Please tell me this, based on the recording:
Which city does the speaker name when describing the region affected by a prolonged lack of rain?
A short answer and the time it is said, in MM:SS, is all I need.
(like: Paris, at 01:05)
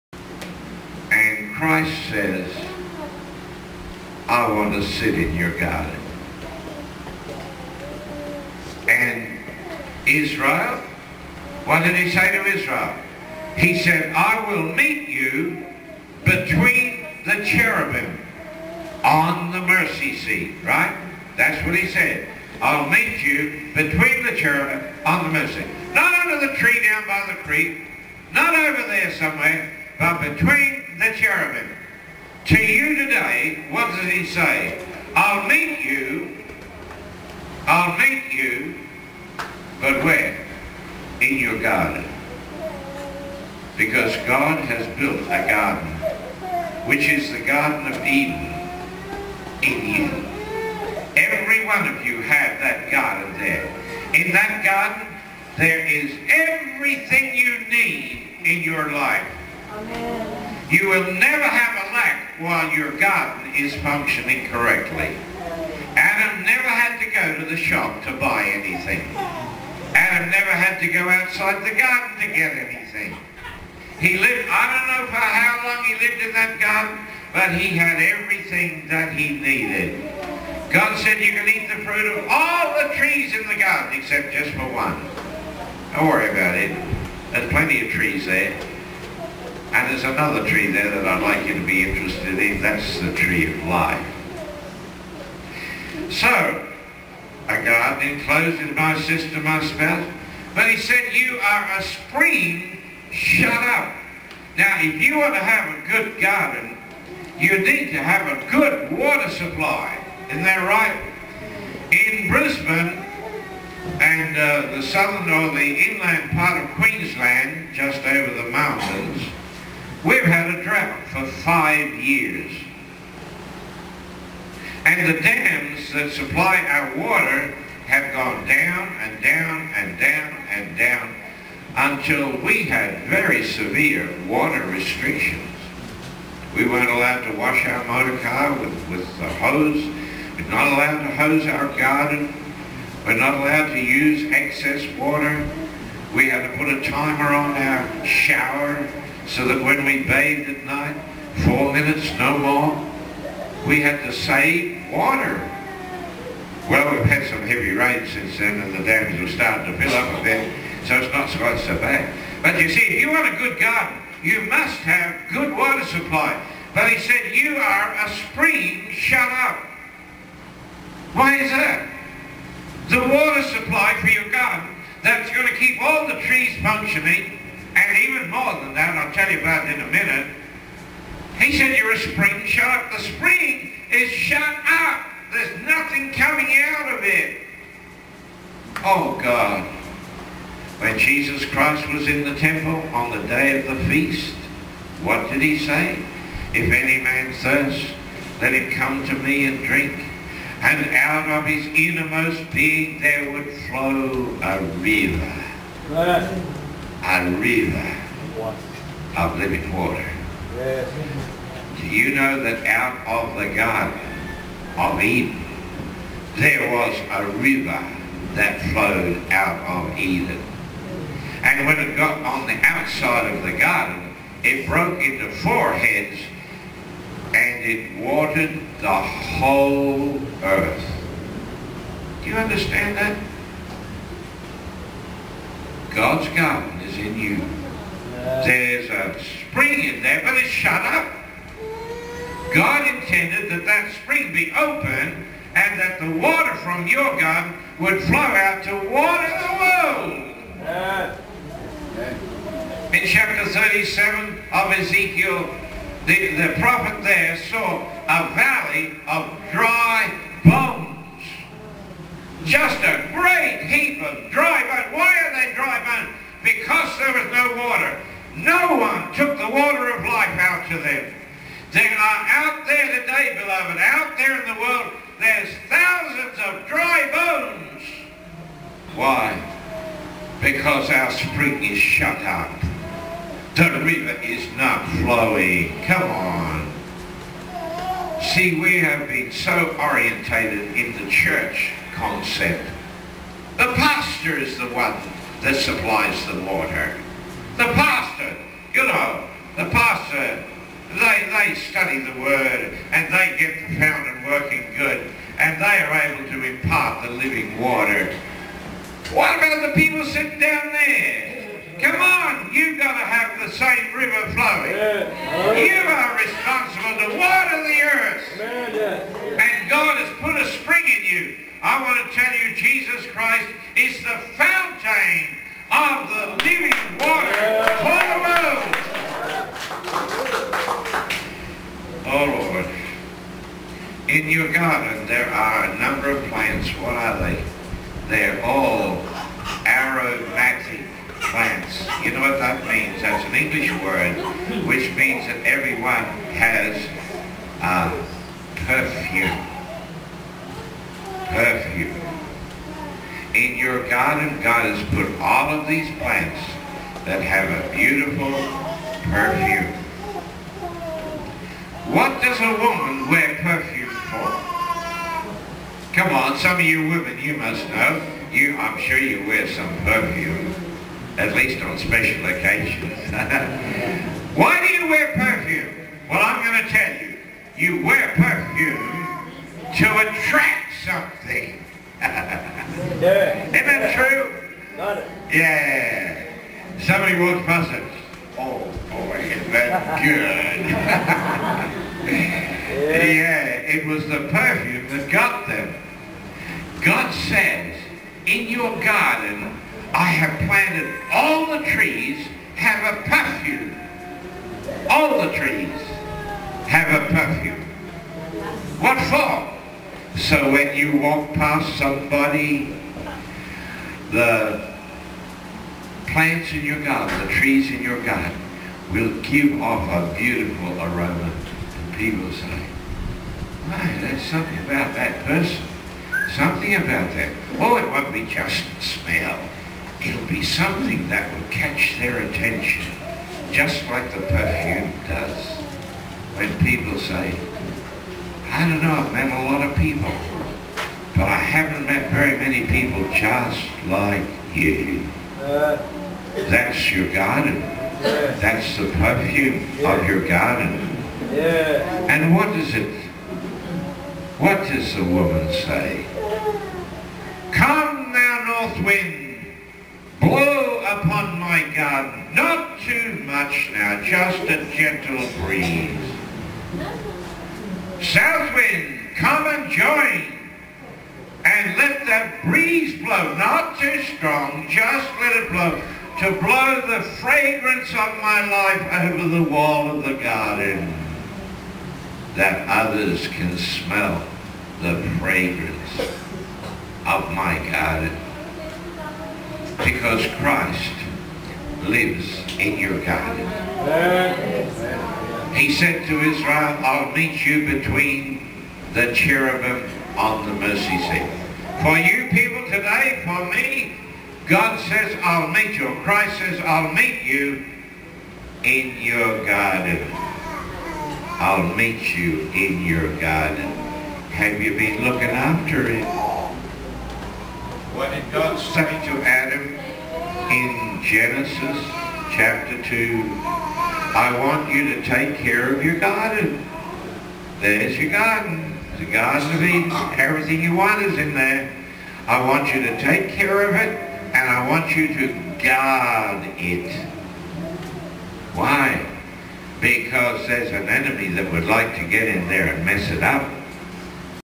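Brisbane, at 01:52.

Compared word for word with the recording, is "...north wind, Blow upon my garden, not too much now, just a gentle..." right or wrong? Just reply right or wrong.
right.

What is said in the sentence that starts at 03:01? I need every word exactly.
He said, you're a spring shut.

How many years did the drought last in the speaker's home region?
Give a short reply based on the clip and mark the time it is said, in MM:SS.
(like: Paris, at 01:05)
5, at 02:01.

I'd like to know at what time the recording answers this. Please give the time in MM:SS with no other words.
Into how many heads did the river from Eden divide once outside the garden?
03:45.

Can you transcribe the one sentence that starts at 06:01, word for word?
What does a woman wear perfume for?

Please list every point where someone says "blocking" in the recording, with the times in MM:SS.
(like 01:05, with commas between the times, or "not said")
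not said.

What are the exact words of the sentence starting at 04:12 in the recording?
In chapter 37 of Ezekiel, the, the prophet there saw a valley of dry bones.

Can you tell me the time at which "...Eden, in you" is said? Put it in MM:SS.
00:48.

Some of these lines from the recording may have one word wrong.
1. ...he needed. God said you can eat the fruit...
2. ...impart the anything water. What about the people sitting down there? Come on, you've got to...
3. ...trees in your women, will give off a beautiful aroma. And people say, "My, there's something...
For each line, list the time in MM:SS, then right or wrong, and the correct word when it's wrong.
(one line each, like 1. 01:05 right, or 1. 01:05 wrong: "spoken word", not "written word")
1. 01:19 right
2. 05:06 wrong: "living", not "anything"
3. 06:57 wrong: "garden", not "women".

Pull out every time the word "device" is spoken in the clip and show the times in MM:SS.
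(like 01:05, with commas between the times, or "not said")
not said.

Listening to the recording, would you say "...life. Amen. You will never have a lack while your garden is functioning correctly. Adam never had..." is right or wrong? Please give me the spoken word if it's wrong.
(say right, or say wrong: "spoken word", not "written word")
right.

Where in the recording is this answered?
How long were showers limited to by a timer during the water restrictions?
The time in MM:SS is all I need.
02:31.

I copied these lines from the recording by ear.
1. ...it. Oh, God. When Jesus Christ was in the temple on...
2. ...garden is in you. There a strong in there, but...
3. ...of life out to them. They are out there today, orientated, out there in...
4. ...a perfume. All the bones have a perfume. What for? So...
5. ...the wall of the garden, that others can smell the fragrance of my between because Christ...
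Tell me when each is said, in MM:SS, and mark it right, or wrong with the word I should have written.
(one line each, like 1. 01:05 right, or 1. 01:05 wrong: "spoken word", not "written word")
1. 03:07 right
2. 03:56 wrong: "spring", not "strong"
3. 04:29 wrong: "beloved", not "orientated"
4. 06:42 wrong: "trees", not "bones"
5. 07:59 wrong: "garden", not "between".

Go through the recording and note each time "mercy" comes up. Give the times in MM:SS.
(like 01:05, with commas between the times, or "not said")
00:19, 00:25, 08:20.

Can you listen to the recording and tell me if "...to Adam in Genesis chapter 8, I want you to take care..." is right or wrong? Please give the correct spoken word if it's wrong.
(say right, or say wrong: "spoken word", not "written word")
wrong: "2", not "8".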